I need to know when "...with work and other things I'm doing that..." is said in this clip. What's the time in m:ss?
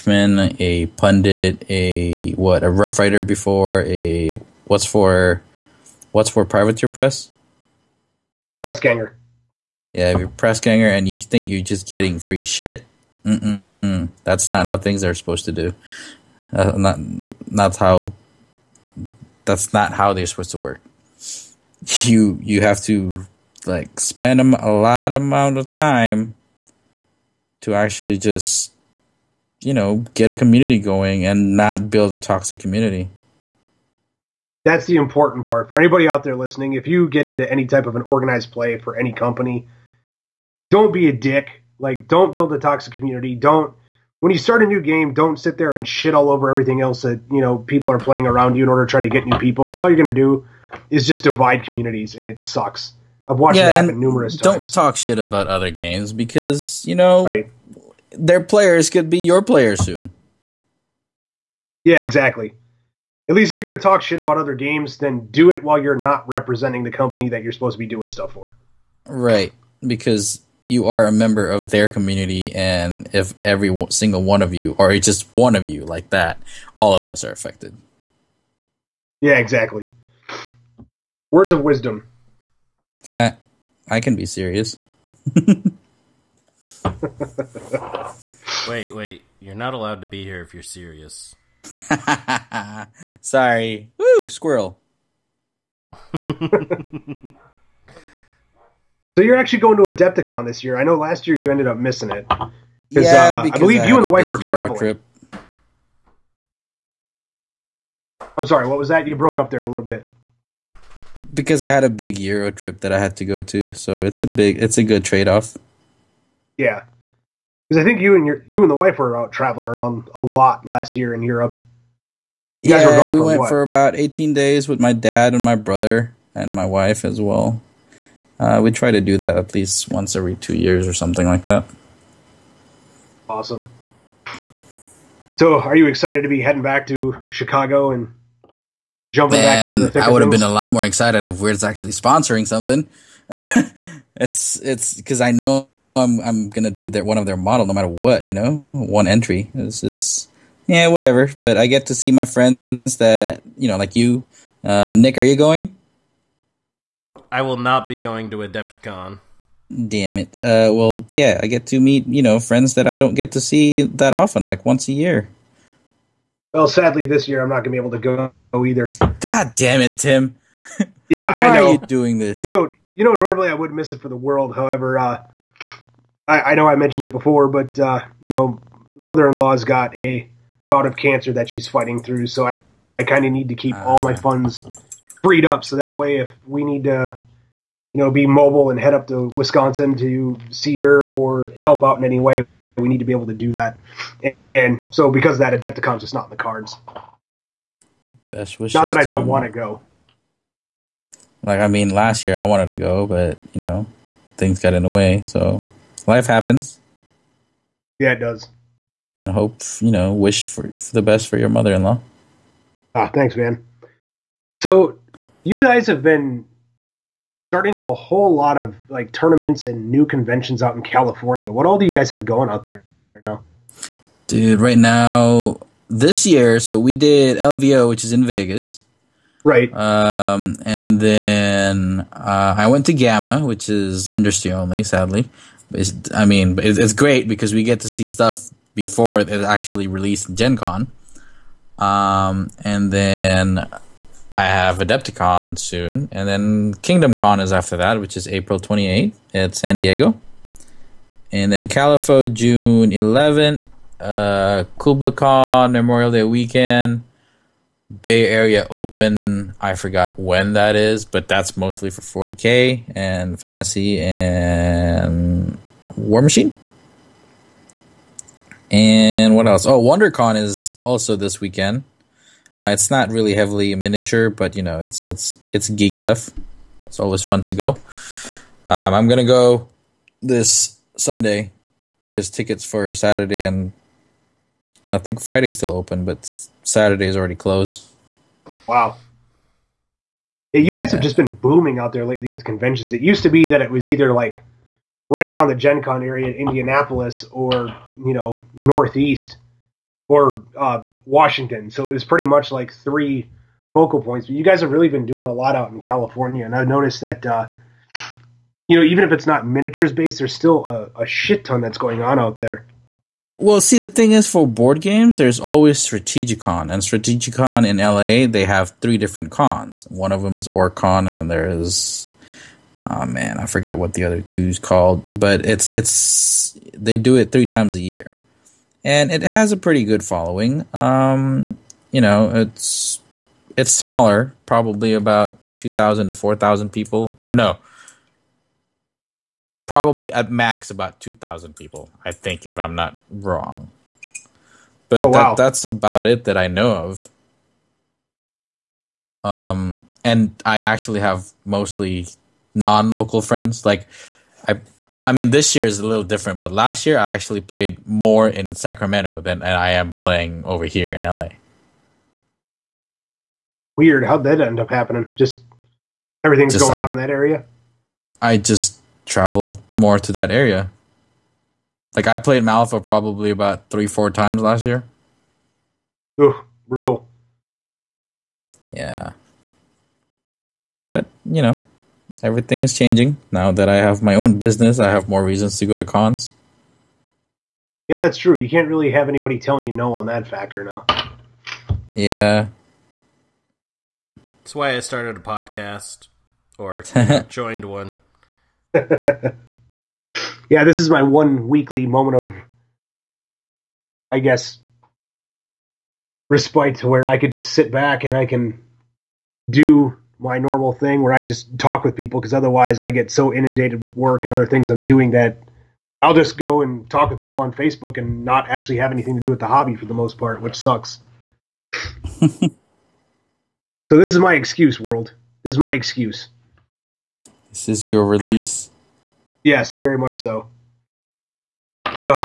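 6:53.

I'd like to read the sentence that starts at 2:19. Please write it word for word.
Thick I would have been a lot more excited if Wyrd's actually sponsoring something.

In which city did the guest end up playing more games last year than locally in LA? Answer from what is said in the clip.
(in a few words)
Sacramento.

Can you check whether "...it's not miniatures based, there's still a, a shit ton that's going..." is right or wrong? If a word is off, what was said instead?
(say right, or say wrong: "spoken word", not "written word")
right.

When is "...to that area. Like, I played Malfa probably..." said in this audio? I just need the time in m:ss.
6:09.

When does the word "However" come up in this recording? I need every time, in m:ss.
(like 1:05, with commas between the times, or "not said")
2:54.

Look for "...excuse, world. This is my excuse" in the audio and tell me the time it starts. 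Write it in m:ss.
7:04.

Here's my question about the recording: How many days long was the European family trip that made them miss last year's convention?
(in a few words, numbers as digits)
18.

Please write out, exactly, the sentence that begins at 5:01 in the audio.
So it was pretty much like three focal points.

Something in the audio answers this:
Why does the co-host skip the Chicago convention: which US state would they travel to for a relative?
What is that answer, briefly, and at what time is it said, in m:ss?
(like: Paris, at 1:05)
Wisconsin, at 3:09.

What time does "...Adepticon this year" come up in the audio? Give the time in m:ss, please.
1:39.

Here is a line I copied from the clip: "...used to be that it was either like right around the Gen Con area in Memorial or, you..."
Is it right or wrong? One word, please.
wrong.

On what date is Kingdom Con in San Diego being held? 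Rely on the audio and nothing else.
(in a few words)
April 28th.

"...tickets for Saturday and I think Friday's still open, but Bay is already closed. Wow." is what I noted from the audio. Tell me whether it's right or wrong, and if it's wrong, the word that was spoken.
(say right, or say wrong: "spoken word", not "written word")
wrong: "Saturday", not "Bay".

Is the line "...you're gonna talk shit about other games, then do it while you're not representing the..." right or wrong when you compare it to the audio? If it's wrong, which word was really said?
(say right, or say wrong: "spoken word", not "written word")
right.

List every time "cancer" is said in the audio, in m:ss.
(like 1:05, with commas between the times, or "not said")
3:00.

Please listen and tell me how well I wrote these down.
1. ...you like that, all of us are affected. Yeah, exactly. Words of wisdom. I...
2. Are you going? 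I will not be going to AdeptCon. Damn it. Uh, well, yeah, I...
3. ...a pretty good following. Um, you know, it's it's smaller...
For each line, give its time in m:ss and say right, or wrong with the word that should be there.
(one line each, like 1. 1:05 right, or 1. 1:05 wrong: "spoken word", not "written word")
1. 1:15 right
2. 2:35 right
3. 5:29 right.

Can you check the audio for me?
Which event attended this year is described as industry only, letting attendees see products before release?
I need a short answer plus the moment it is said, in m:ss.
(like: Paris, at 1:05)
GAMA, at 3:52.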